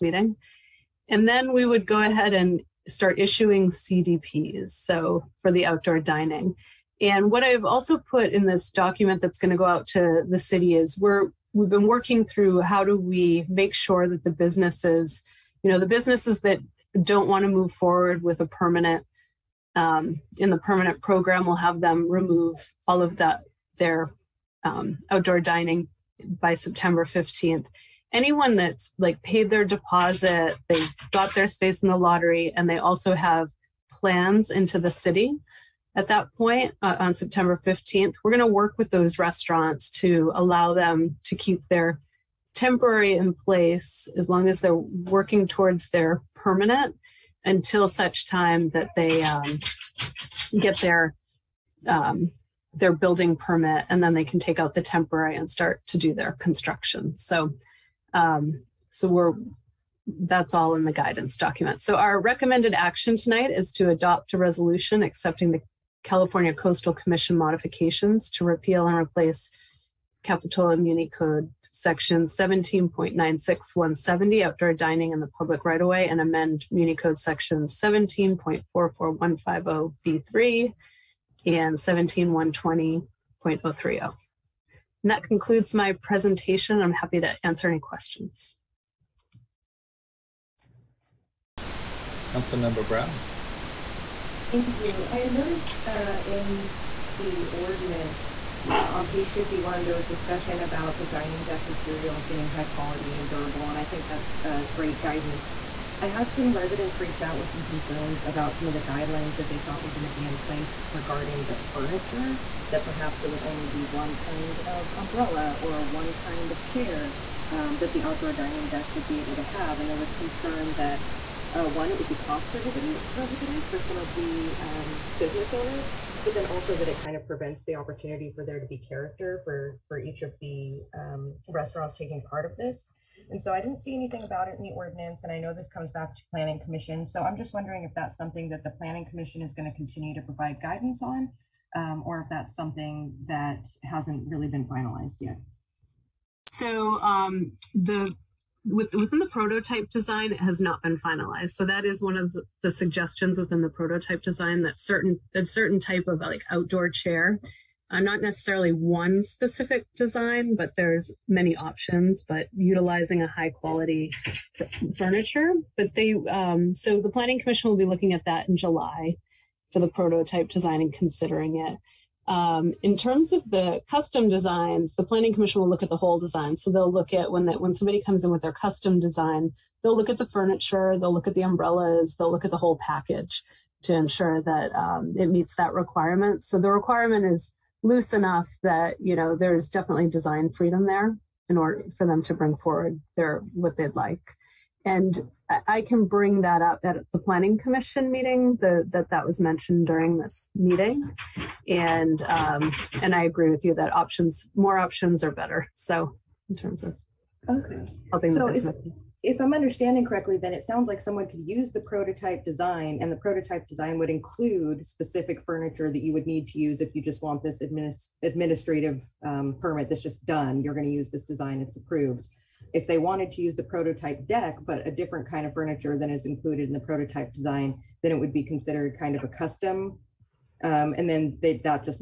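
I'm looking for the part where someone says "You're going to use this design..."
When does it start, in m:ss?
3:40.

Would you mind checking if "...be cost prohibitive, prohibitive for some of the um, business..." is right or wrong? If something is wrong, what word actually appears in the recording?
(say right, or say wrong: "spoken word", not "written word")
right.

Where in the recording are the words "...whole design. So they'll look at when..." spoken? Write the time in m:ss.
2:55.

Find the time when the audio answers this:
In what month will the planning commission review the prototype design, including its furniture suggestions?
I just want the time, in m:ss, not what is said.
2:48.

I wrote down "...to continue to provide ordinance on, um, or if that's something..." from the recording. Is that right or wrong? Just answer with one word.
wrong.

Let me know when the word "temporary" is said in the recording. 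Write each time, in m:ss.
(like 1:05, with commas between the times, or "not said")
0:42, 0:54.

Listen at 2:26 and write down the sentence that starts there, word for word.
So um, the with, within the prototype design, it has not been finalized.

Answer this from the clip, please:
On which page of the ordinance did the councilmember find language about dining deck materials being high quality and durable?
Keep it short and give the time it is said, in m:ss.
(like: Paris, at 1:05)
51, at 1:39.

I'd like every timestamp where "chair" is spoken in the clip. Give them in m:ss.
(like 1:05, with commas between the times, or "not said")
1:56, 2:36.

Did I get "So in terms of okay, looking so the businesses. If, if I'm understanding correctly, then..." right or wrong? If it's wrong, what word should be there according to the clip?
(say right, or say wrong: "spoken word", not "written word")
wrong: "helping", not "looking".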